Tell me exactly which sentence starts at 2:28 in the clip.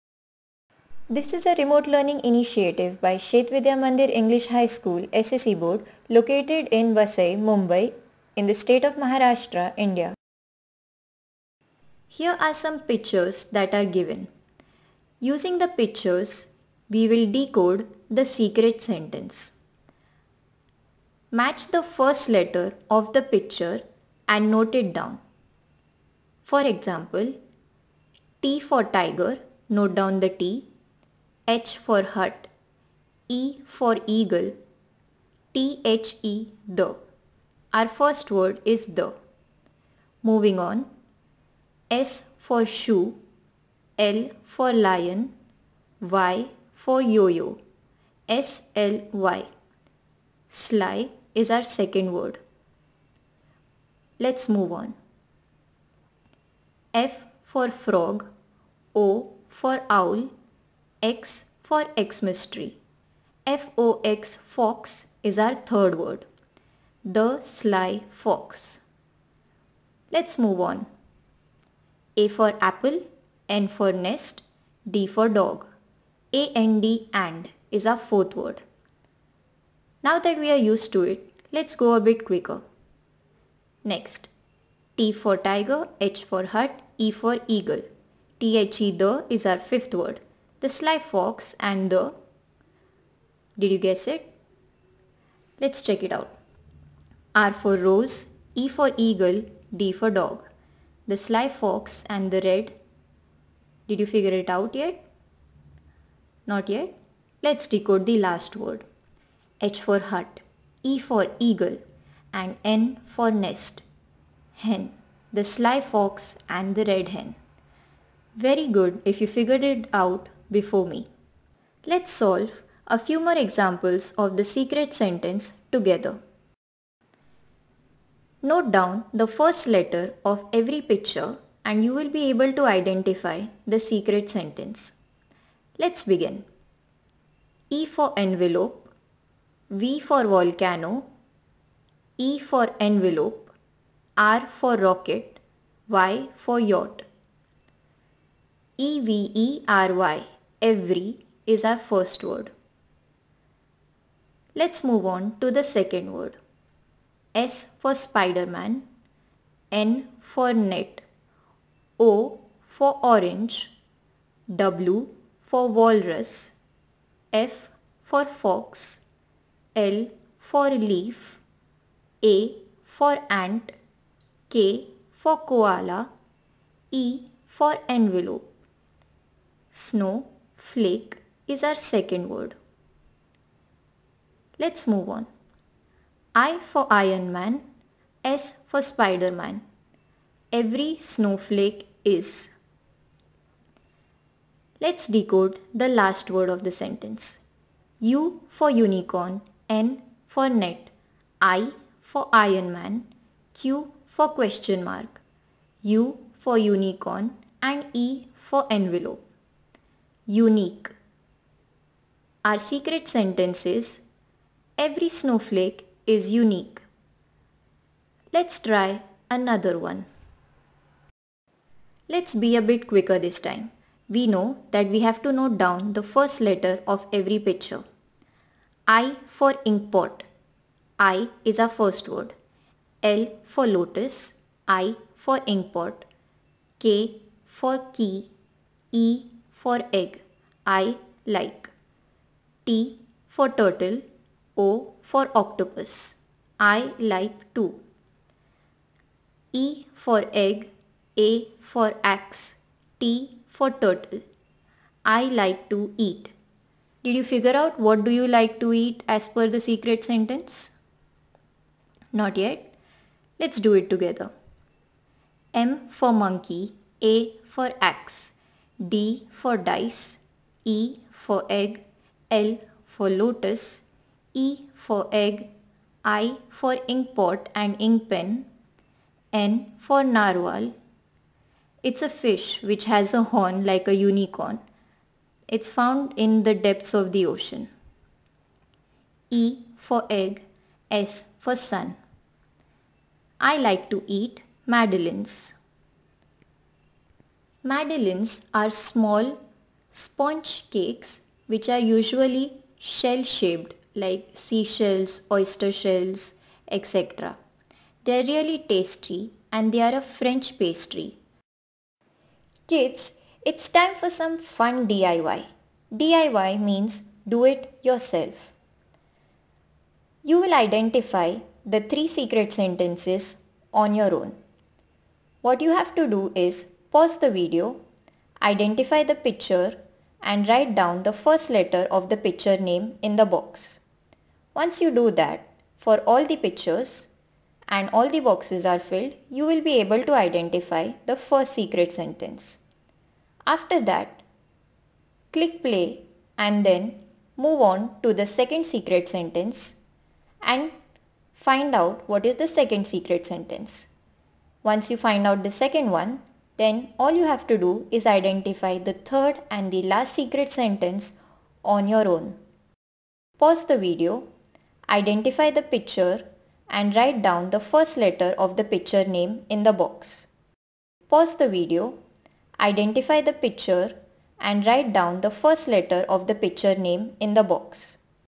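E-V-E-R-Y every is our first word.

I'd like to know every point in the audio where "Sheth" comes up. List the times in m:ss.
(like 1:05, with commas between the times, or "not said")
0:03.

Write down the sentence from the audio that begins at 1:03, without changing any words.
FOX fox is our third word.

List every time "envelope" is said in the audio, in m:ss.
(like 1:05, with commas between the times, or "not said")
2:18, 2:22, 2:57, 3:28.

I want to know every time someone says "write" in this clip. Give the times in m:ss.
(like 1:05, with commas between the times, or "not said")
5:30, 6:06, 6:14.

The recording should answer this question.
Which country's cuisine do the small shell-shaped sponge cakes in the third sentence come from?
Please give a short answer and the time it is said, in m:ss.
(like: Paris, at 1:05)
French, at 5:10.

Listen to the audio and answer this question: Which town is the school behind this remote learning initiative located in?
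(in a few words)
Vasai.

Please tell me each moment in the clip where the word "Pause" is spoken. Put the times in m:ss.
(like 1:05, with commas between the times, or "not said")
5:26, 6:03, 6:11.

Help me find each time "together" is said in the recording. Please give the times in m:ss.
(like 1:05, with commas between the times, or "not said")
2:05, 4:23.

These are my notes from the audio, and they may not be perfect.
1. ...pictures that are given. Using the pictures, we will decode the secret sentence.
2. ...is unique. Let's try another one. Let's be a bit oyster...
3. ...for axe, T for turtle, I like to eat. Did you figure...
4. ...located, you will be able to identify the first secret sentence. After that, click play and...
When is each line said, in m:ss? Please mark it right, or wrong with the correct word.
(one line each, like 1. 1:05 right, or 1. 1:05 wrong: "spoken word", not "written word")
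1. 0:12 right
2. 3:36 wrong: "quicker", not "oyster"
3. 4:11 right
4. 5:38 wrong: "filled", not "located".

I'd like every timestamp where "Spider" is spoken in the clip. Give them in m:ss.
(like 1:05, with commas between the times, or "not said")
2:37, 3:08.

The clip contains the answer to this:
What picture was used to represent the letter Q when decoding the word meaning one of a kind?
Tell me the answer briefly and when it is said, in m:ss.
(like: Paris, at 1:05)
Question mark, at 3:24.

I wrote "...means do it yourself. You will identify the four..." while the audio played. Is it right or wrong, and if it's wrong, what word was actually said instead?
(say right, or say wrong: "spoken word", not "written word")
wrong: "three", not "four".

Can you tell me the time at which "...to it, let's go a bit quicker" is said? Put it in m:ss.
1:20.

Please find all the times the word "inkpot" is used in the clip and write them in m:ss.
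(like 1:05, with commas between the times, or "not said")
3:49, 3:55, 4:36.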